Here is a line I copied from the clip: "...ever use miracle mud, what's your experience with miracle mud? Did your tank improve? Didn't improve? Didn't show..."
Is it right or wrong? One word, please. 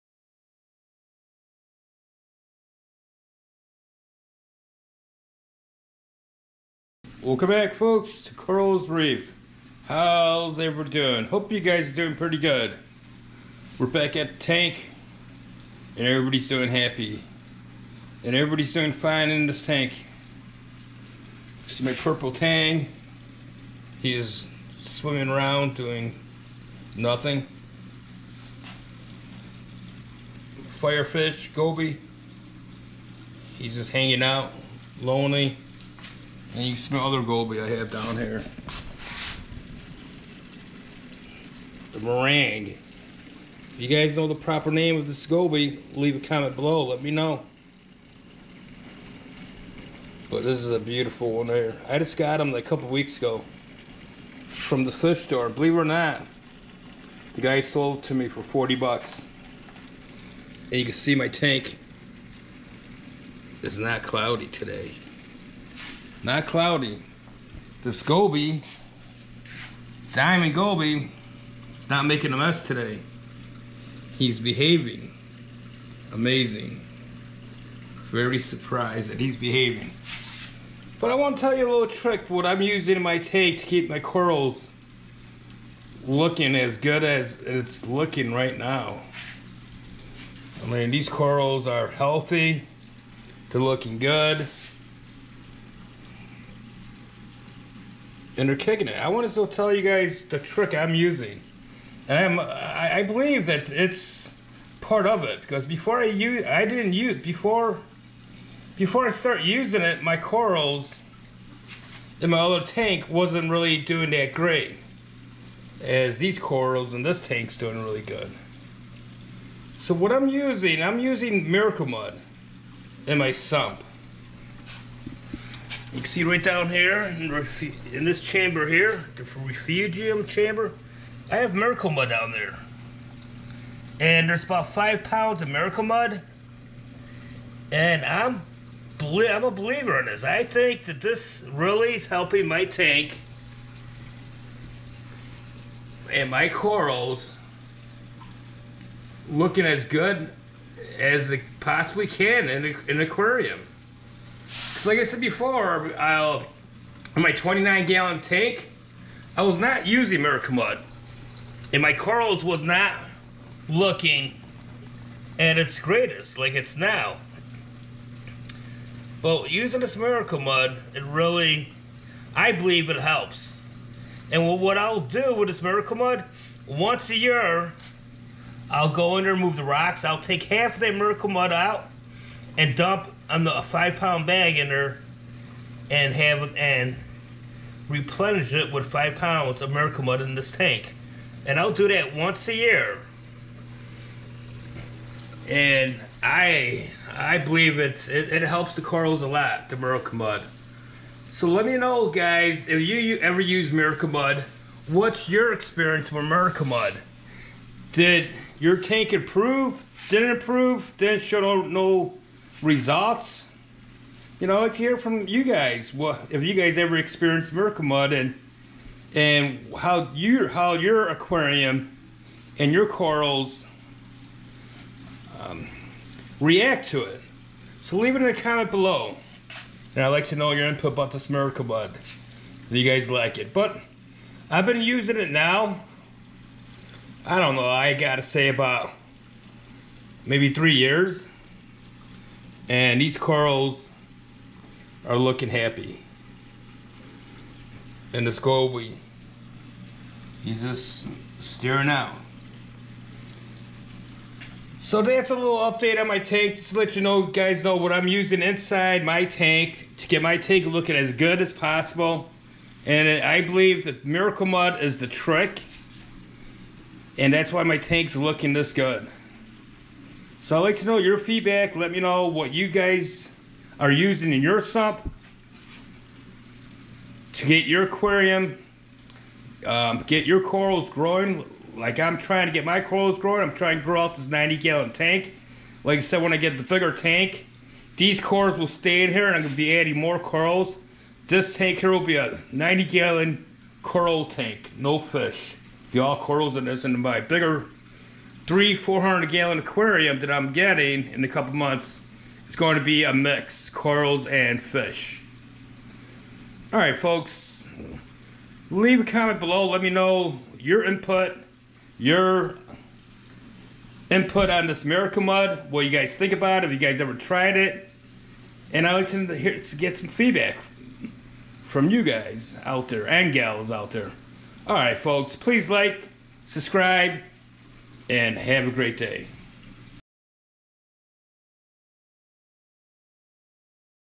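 right.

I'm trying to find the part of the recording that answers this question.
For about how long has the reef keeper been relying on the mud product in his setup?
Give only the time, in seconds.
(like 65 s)
240 s.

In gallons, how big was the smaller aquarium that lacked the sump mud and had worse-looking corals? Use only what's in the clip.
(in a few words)
29 gallon.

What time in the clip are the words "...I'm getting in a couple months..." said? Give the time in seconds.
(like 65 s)
300 s.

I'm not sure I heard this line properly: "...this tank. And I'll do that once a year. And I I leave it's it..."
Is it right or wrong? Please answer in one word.
wrong.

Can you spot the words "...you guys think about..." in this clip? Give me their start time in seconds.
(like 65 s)
315 s.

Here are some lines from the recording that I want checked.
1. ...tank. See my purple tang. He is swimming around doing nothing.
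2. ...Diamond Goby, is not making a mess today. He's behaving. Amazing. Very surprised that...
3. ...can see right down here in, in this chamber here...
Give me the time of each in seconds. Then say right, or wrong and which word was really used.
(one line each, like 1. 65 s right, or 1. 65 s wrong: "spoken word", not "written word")
1. 19 s right
2. 70 s right
3. 125 s right.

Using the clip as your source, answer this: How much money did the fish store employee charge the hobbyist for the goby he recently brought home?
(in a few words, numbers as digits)
$40.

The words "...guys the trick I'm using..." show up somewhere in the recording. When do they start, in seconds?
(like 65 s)
99 s.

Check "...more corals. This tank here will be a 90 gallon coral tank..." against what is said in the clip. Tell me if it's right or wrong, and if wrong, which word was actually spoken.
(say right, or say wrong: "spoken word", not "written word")
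right.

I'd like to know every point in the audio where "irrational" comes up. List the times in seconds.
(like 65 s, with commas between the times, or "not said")
not said.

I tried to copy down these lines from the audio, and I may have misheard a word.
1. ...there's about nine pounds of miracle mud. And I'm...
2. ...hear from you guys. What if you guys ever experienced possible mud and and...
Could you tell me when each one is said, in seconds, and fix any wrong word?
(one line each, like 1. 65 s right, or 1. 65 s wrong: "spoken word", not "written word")
1. 134 s wrong: "five", not "nine"
2. 214 s wrong: "miracle", not "possible".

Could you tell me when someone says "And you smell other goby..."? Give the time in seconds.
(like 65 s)
36 s.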